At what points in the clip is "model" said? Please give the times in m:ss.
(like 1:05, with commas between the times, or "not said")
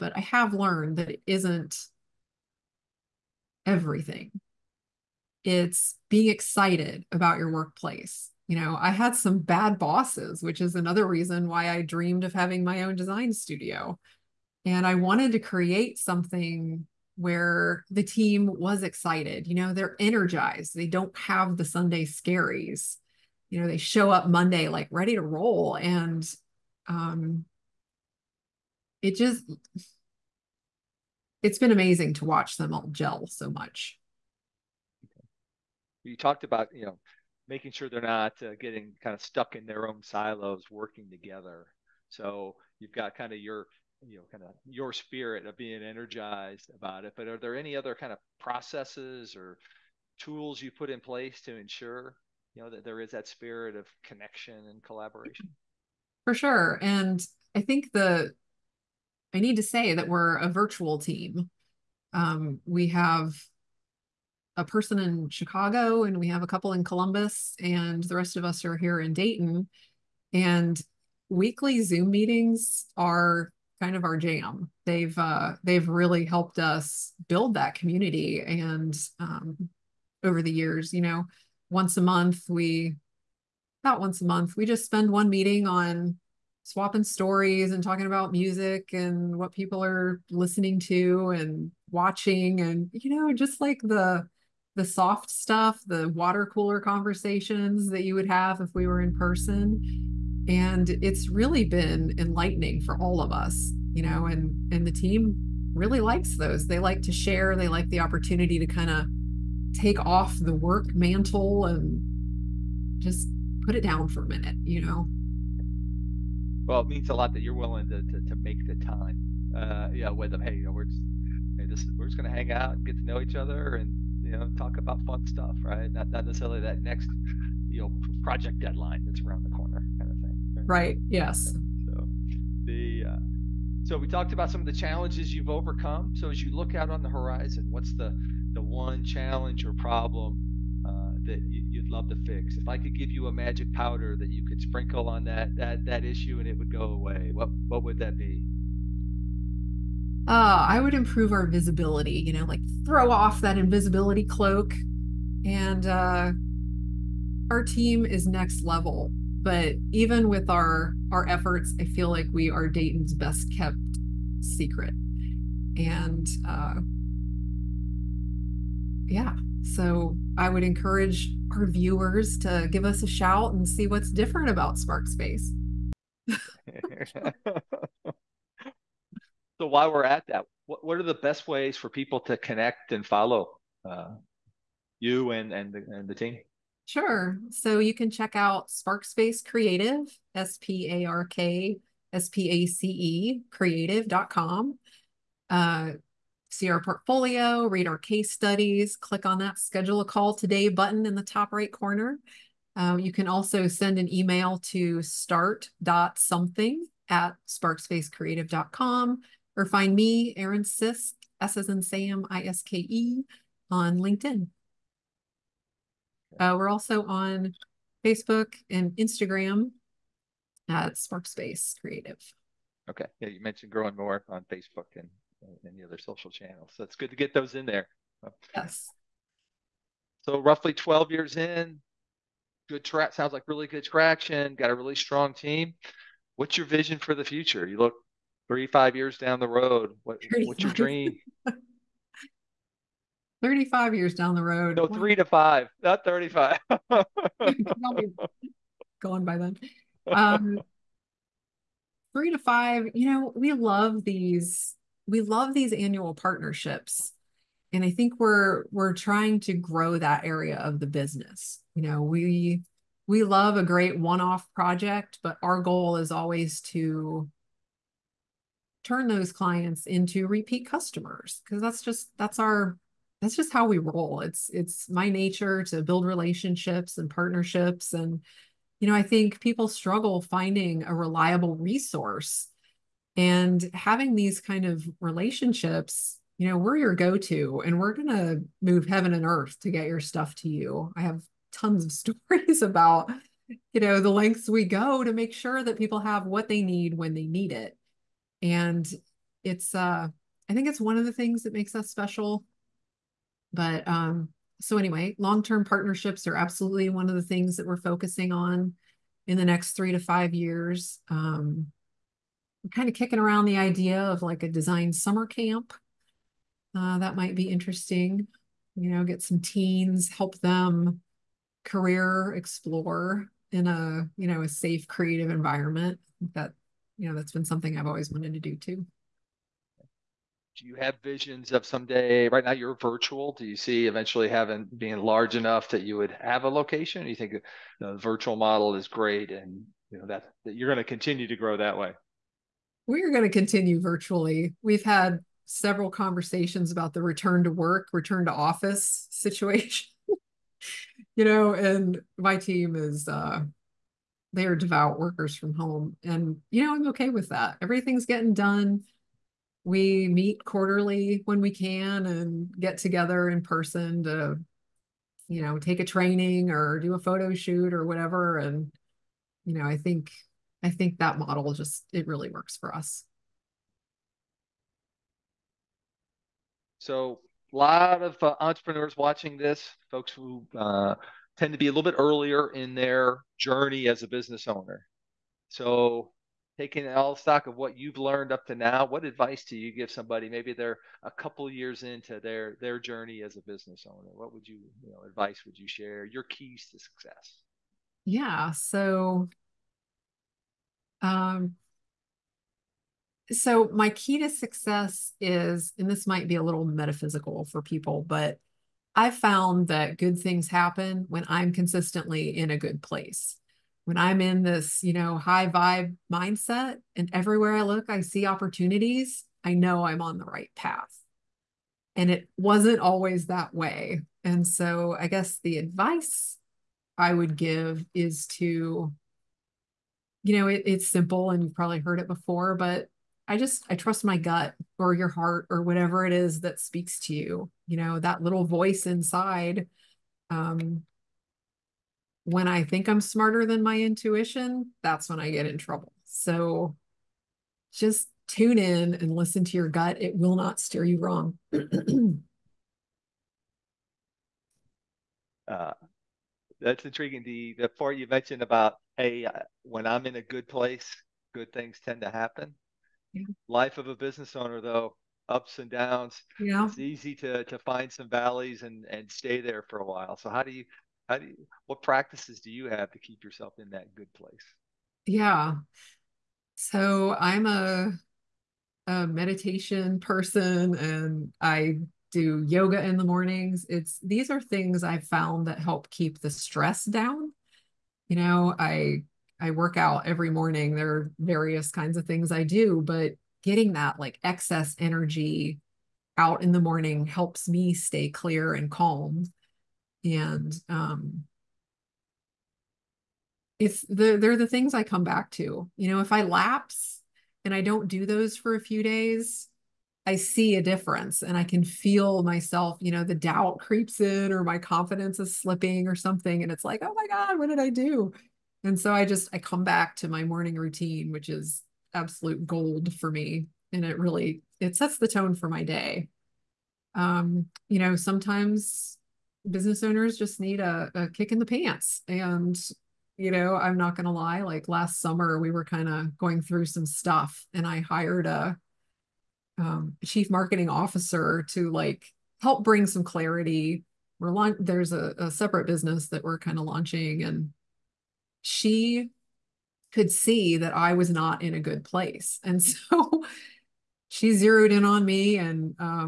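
5:38, 6:11.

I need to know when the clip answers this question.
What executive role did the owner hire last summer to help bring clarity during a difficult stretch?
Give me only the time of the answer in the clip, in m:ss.
9:00.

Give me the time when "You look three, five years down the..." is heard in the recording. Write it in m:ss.
3:57.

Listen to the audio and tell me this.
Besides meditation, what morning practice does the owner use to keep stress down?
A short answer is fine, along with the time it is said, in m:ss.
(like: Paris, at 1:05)
yoga, at 8:02.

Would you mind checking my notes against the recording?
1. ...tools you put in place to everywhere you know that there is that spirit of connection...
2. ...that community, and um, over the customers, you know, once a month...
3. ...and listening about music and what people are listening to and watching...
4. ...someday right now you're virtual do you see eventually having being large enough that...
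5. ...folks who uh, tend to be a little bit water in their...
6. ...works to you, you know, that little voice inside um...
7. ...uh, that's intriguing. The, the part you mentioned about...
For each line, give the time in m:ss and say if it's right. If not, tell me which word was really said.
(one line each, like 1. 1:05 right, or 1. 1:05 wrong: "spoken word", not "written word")
1. 0:50 wrong: "ensure", not "everywhere"
2. 1:17 wrong: "years", not "customers"
3. 1:27 wrong: "talking", not "listening"
4. 5:31 right
5. 6:19 wrong: "earlier", not "water"
6. 7:16 wrong: "speaks", not "works"
7. 7:35 right.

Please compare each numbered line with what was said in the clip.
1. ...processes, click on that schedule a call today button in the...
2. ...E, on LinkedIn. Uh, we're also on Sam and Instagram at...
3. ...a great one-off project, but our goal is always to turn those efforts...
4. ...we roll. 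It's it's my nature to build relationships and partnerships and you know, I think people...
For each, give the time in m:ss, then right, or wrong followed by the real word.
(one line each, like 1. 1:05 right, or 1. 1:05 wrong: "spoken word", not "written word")
1. 3:18 wrong: "studies", not "processes"
2. 3:32 wrong: "Facebook", not "Sam"
3. 4:23 wrong: "clients", not "efforts"
4. 4:33 right.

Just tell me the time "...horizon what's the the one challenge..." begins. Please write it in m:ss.
2:17.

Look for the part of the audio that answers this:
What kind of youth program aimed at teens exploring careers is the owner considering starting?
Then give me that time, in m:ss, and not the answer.
5:14.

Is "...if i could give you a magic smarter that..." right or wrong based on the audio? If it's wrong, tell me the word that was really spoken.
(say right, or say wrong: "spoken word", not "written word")
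wrong: "powder", not "smarter".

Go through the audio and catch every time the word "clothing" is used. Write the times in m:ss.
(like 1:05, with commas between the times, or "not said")
not said.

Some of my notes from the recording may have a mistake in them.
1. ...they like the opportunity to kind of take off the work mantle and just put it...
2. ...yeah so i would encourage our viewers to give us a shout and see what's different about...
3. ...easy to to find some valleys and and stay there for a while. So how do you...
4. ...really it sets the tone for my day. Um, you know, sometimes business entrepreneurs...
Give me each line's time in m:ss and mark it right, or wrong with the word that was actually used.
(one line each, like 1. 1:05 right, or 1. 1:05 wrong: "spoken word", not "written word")
1. 1:47 right
2. 2:49 right
3. 7:46 right
4. 8:43 wrong: "owners", not "entrepreneurs".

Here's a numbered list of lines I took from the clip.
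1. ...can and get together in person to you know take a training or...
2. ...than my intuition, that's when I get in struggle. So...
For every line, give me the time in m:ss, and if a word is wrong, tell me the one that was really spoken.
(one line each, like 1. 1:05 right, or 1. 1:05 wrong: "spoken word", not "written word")
1. 6:01 right
2. 7:23 wrong: "trouble", not "struggle".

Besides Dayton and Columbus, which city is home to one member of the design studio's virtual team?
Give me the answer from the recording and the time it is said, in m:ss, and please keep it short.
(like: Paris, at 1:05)
Chicago, at 1:05.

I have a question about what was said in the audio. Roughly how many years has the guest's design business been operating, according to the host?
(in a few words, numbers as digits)
12.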